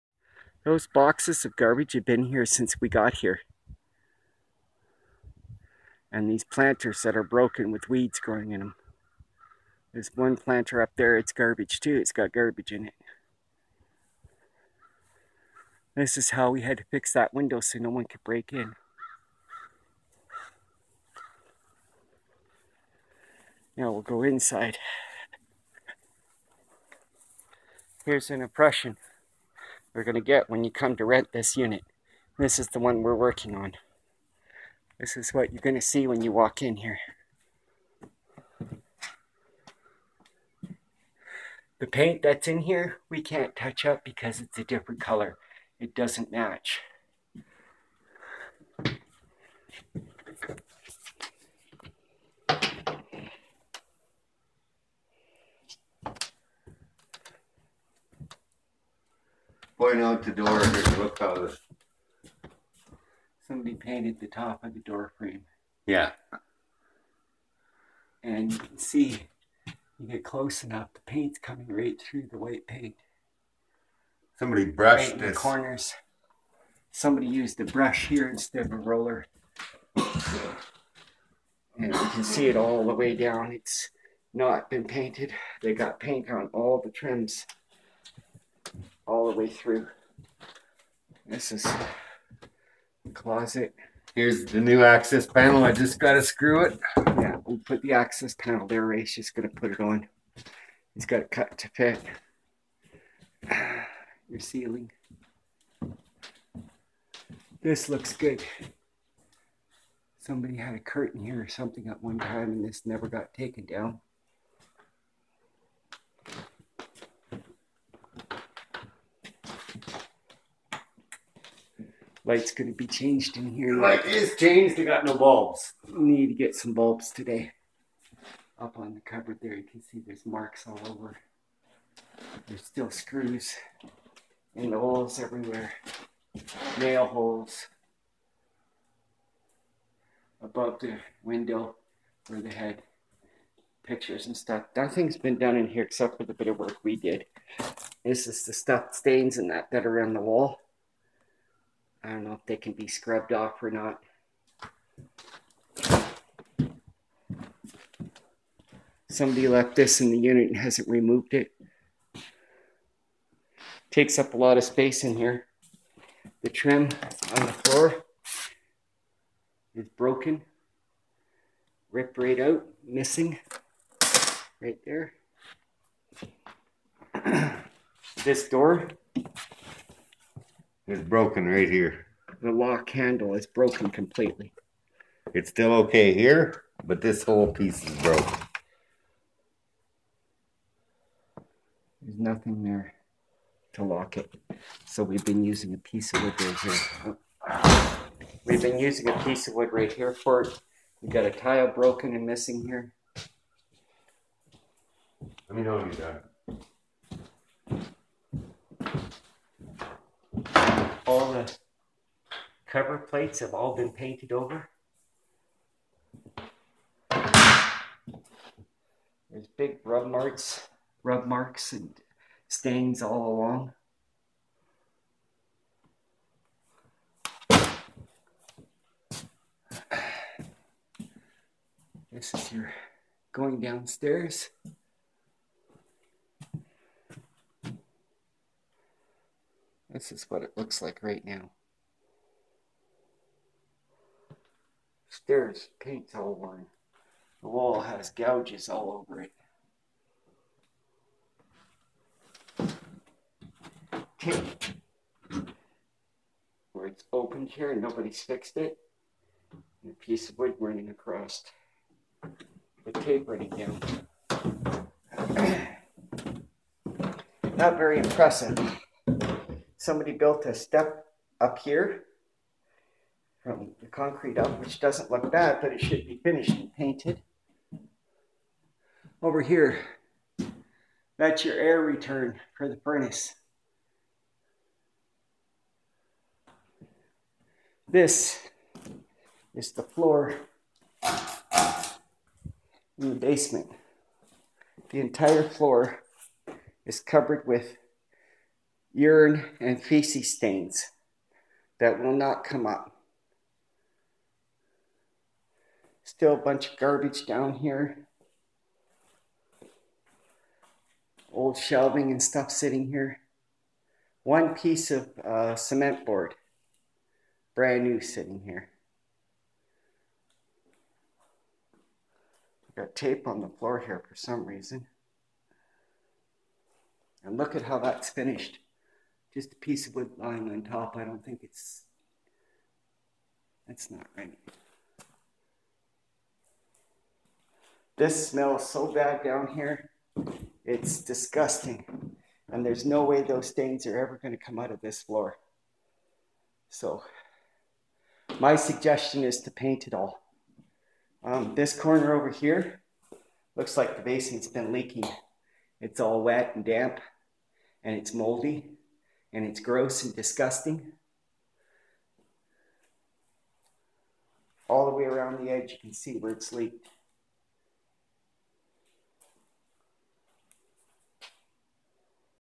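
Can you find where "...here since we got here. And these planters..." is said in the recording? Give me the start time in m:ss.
0:02.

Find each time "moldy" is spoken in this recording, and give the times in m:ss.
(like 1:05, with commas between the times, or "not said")
5:58.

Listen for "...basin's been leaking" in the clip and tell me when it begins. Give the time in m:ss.
5:54.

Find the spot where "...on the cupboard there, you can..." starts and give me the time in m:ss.
2:08.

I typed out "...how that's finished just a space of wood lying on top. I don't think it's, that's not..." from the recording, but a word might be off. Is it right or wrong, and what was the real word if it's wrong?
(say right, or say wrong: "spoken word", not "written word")
wrong: "piece", not "space".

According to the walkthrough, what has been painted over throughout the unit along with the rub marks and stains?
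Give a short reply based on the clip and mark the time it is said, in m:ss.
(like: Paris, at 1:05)
Cover plates, at 3:32.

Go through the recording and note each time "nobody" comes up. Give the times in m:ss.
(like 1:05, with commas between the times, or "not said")
4:17.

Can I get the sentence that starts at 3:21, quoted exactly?
We've got a tile broken and missing here.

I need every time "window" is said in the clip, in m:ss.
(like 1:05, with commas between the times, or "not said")
0:17, 2:21.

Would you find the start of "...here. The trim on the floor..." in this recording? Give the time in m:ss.
2:45.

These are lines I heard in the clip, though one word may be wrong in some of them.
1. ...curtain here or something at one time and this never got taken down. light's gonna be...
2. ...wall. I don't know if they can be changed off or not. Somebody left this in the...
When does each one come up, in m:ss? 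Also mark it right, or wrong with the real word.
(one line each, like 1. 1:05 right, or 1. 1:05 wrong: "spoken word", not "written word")
1. 1:50 right
2. 2:30 wrong: "scrubbed", not "changed".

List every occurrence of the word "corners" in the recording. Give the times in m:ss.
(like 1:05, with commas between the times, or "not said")
1:15, 5:51.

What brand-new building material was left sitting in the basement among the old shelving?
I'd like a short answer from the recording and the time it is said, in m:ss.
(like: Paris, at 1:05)
Cement board, at 5:15.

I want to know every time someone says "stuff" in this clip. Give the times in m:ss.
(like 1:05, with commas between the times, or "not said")
2:24, 2:28, 5:12.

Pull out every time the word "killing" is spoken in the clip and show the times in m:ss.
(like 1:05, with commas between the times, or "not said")
not said.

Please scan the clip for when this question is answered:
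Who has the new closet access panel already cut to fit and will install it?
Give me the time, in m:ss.
1:38.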